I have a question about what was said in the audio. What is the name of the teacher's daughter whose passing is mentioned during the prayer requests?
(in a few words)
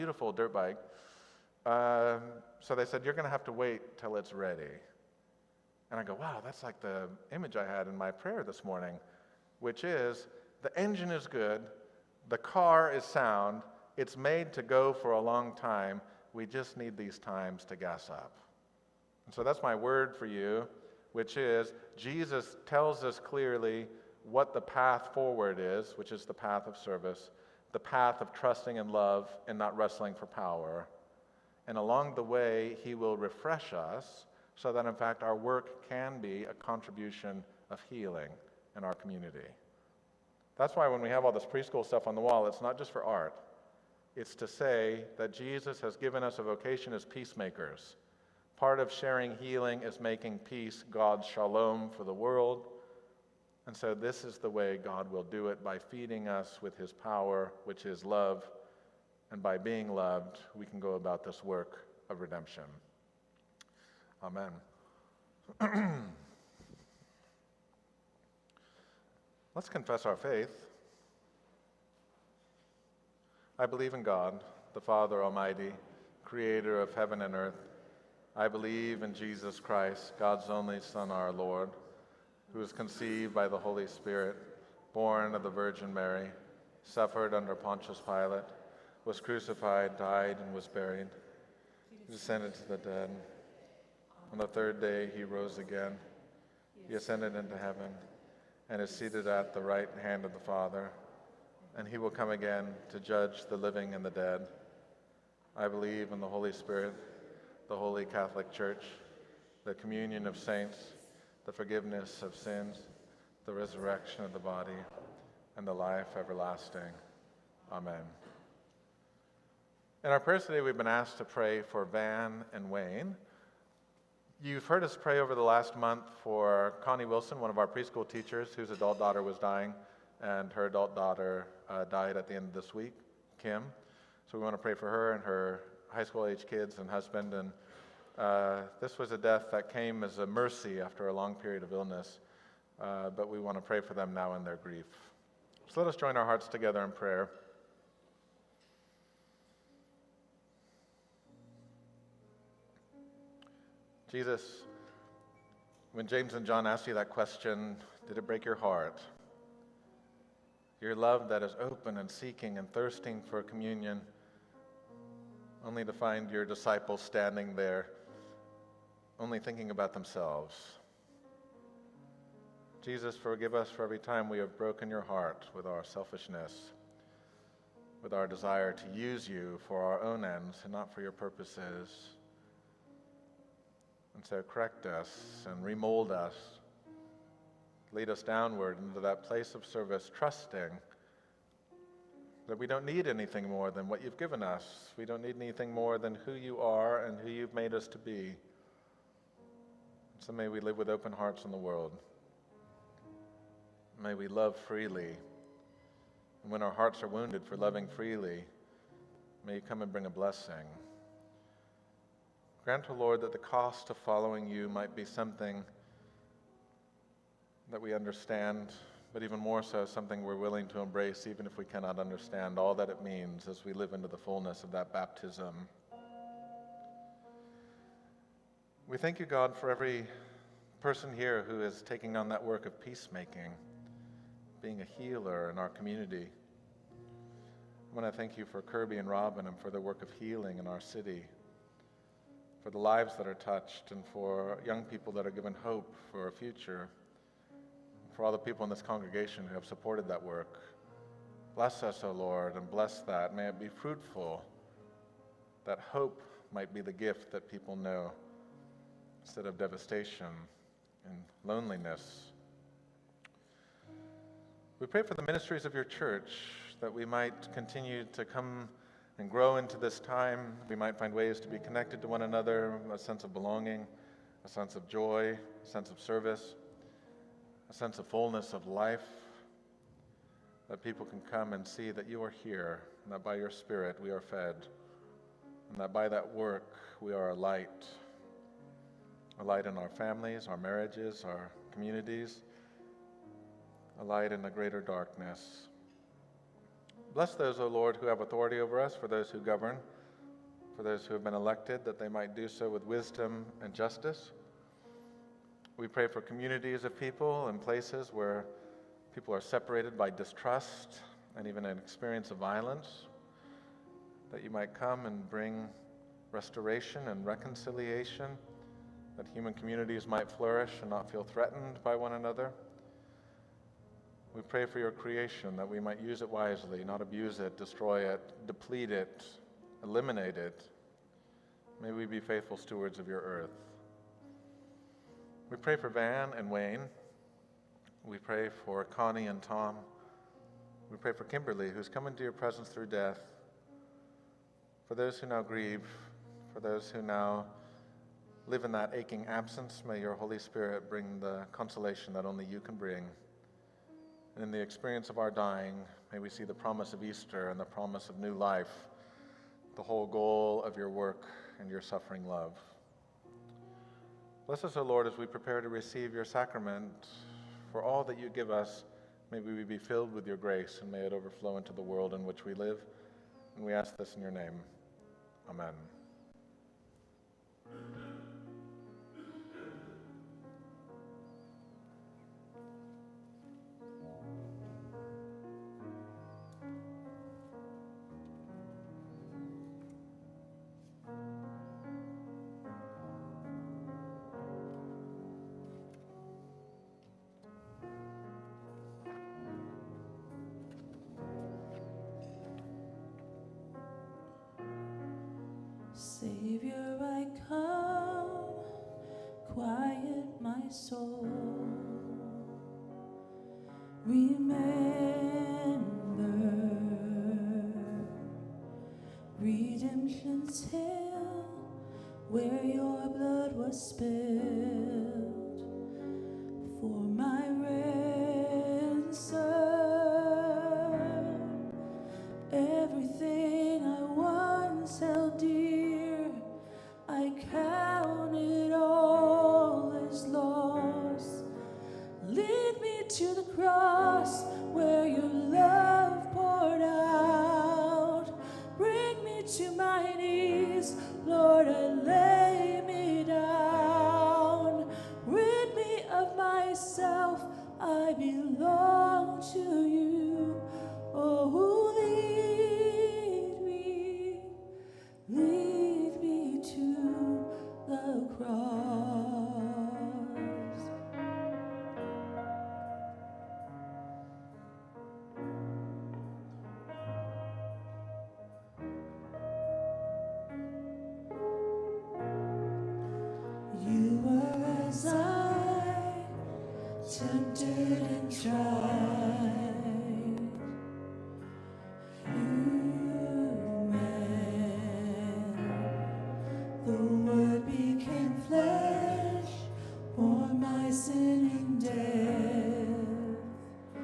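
Kim.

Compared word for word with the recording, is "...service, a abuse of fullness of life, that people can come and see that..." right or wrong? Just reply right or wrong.
wrong.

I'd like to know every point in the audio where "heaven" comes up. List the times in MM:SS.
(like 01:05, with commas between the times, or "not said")
01:16, 01:37.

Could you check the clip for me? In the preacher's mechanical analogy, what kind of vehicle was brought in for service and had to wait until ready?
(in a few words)
dirt bike.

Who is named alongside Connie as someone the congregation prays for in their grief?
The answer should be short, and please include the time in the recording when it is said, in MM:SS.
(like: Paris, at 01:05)
Tom, at 05:39.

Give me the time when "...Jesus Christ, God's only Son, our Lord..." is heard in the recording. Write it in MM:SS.
01:19.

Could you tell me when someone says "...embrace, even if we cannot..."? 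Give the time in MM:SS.
03:40.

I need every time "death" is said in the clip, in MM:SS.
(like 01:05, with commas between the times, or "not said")
02:19, 05:42.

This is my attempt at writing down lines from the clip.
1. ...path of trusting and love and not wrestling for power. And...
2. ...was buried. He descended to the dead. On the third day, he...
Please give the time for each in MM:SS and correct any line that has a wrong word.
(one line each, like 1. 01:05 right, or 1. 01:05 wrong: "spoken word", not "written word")
1. 00:27 right
2. 01:30 right.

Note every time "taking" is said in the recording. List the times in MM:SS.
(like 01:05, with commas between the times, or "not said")
03:51.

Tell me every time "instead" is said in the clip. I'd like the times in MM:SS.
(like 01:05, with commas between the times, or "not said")
04:19.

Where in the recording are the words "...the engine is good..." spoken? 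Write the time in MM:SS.
00:10.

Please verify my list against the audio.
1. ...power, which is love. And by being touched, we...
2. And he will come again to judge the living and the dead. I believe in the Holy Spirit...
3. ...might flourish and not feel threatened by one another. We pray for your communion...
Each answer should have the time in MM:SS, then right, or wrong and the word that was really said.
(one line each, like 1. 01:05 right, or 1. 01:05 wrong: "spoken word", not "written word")
1. 00:56 wrong: "loved", not "touched"
2. 01:41 right
3. 05:20 wrong: "creation", not "communion".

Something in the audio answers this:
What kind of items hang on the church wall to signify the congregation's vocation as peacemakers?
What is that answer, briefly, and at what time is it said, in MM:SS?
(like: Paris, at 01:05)
preschool stuff, at 00:41.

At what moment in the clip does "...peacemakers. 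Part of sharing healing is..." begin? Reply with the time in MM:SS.
00:47.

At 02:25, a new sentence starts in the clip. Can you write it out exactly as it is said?
So let us join our hearts together in prayer.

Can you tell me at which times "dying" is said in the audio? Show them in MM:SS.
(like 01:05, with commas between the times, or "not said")
02:09, 05:55.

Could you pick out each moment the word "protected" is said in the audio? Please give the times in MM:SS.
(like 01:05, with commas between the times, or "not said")
not said.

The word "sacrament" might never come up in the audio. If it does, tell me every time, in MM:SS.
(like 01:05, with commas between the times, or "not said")
06:06.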